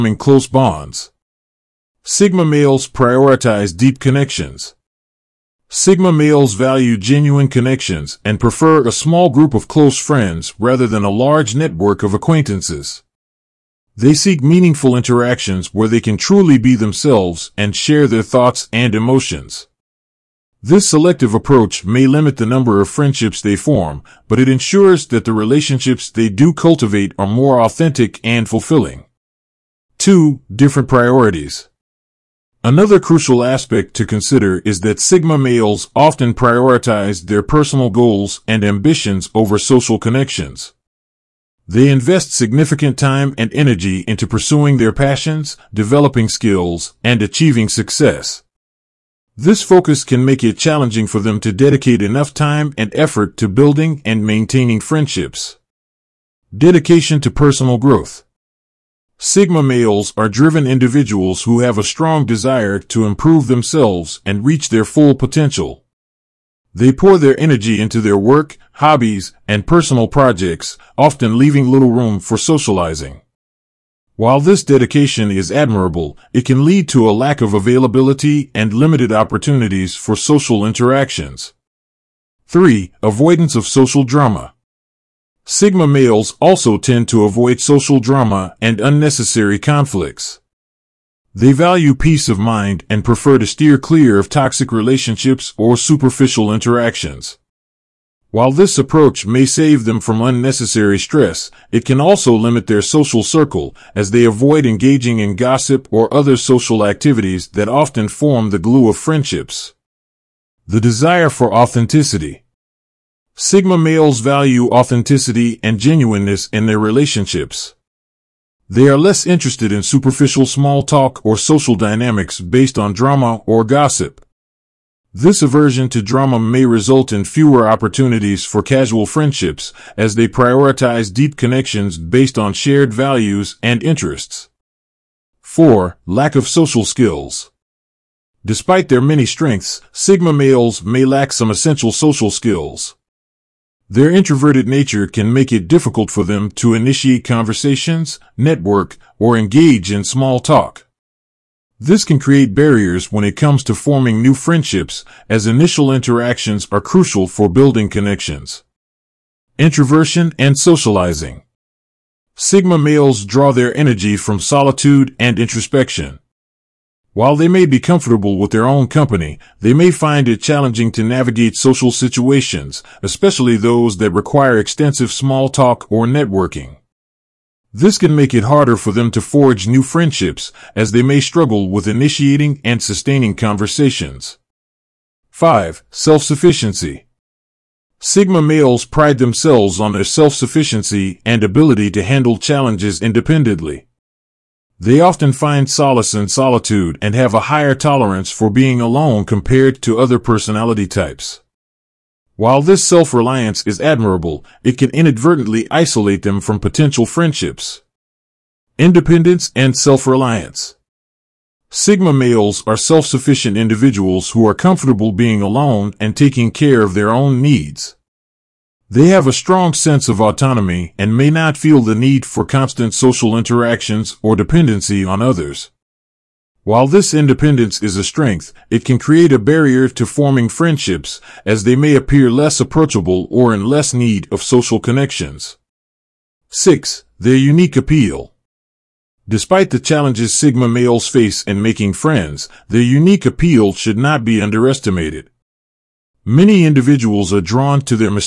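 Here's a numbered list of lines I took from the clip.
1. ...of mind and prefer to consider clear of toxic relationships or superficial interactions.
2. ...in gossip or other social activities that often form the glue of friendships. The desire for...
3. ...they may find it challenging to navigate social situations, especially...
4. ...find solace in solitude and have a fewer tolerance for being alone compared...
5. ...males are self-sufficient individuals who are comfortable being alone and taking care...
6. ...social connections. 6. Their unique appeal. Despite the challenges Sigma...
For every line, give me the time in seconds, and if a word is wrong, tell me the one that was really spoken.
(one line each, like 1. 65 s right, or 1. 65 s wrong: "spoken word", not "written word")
1. 92 s wrong: "steer", not "consider"
2. 105 s right
3. 169 s right
4. 195 s wrong: "higher", not "fewer"
5. 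212 s right
6. 234 s right.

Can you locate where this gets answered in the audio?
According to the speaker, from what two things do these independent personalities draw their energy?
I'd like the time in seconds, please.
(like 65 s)
164 s.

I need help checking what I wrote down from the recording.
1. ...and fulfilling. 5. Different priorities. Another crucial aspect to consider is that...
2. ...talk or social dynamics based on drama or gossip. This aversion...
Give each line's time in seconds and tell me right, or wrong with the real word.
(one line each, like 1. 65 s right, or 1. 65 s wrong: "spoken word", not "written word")
1. 28 s wrong: "2", not "5"
2. 120 s right.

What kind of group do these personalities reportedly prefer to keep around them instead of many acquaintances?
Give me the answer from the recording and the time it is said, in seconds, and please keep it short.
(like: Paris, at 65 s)
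small group of close friends, at 8 s.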